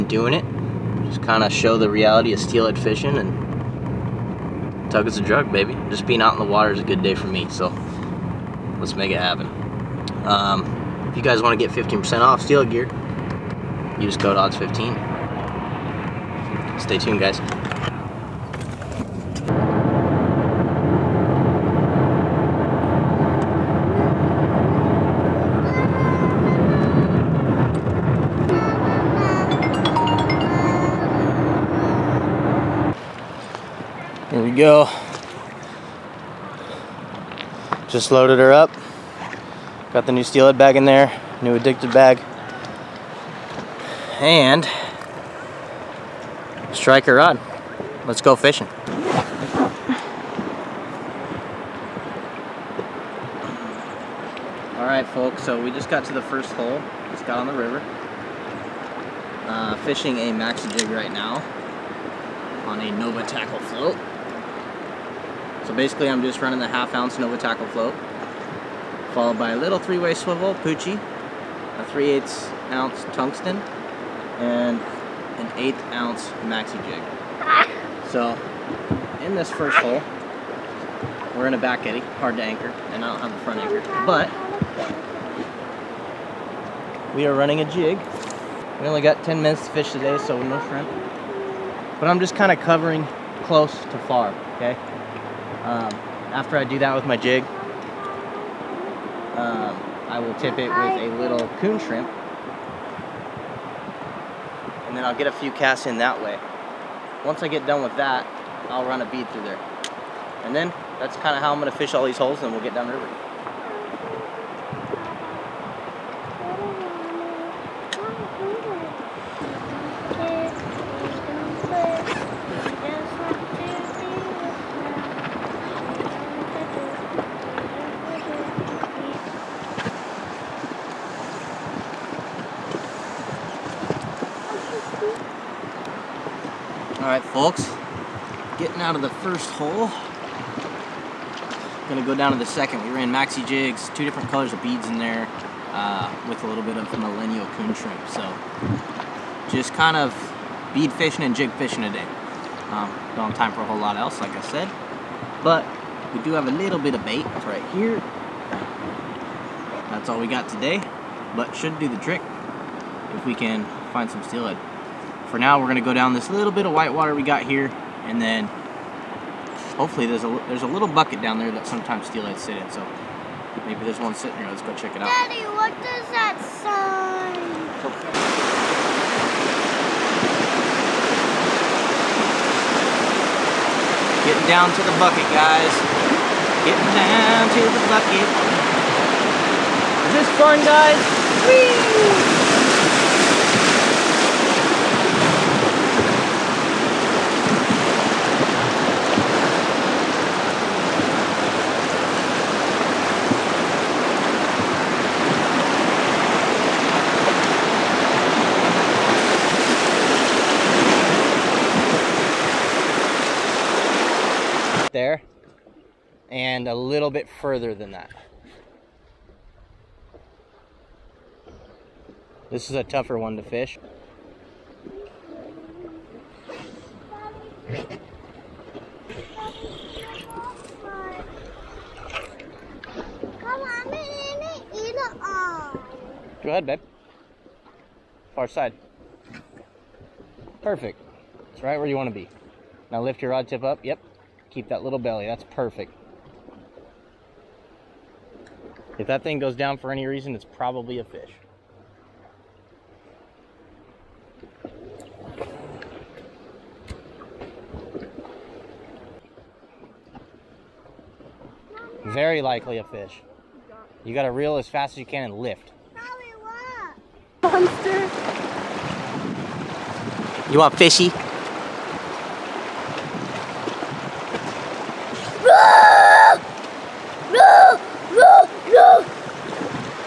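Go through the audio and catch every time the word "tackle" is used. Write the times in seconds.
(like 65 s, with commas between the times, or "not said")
63 s, 67 s.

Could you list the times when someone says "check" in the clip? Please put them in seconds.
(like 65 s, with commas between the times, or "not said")
174 s.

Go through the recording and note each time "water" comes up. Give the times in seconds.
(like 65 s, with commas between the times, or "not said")
6 s, 166 s.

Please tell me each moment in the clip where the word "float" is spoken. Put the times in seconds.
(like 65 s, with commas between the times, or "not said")
63 s, 67 s.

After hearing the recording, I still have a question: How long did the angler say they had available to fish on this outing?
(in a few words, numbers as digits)
10 minutes.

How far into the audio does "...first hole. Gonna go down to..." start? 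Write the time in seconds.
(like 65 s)
139 s.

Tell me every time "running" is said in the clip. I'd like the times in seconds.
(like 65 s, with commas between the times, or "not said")
66 s, 87 s.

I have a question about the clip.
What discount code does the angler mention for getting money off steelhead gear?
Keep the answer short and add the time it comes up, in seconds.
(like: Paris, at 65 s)
odds15, at 14 s.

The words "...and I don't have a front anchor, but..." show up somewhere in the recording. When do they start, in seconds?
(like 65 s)
82 s.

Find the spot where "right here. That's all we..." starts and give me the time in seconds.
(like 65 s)
157 s.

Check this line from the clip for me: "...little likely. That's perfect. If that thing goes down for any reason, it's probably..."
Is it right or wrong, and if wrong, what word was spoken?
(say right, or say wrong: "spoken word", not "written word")
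wrong: "belly", not "likely".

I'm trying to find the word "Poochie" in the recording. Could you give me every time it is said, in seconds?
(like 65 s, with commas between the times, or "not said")
70 s.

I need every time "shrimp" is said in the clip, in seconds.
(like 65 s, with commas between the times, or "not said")
90 s, 101 s, 147 s.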